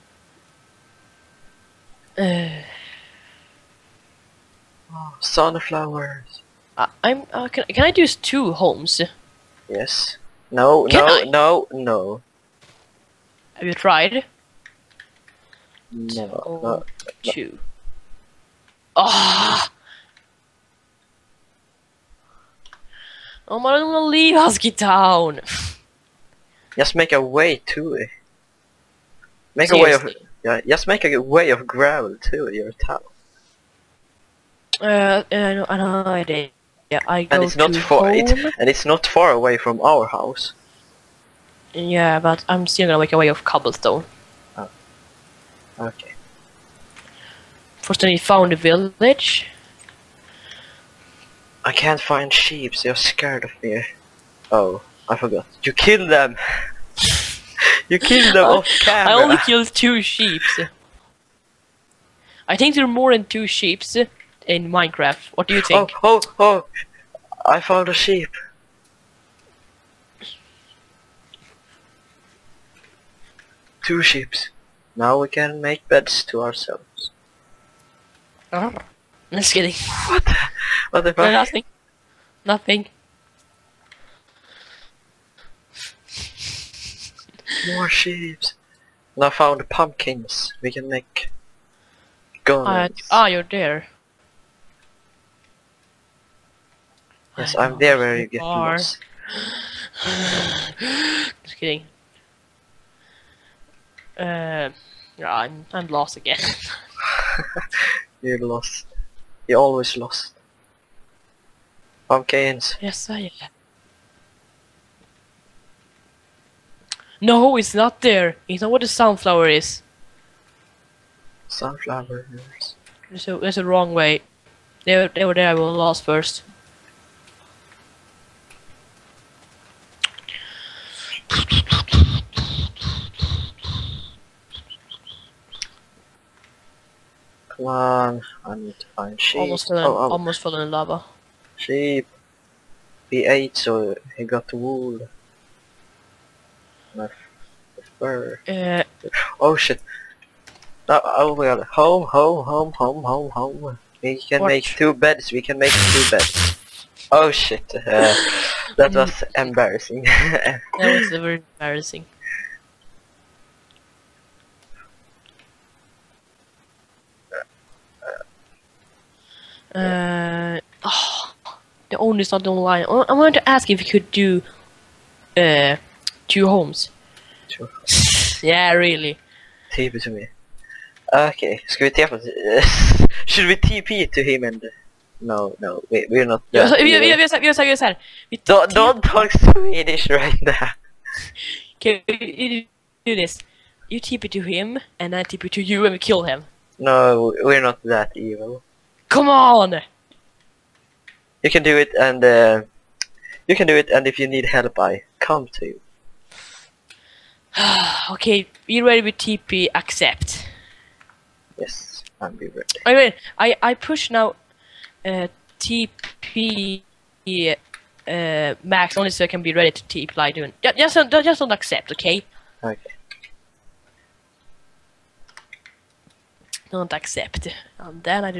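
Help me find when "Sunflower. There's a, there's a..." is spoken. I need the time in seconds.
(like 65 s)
121 s.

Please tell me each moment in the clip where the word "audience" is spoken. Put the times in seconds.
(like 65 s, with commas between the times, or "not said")
not said.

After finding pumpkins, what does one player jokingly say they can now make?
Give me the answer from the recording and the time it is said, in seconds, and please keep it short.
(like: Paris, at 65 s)
guns, at 92 s.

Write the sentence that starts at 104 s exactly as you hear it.
Uh, yeah, I'm I'm lost again.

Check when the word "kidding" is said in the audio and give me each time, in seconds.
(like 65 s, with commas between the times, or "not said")
79 s, 101 s.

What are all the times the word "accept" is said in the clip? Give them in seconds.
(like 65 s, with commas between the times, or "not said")
209 s, 221 s, 226 s.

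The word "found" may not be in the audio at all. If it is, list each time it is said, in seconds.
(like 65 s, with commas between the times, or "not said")
48 s, 67 s, 89 s.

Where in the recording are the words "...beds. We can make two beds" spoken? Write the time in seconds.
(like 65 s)
154 s.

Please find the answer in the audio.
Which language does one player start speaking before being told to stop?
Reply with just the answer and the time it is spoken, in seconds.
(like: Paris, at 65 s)
Swedish, at 189 s.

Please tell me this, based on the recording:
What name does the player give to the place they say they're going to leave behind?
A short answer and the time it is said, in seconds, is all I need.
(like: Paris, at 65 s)
Husky Town, at 24 s.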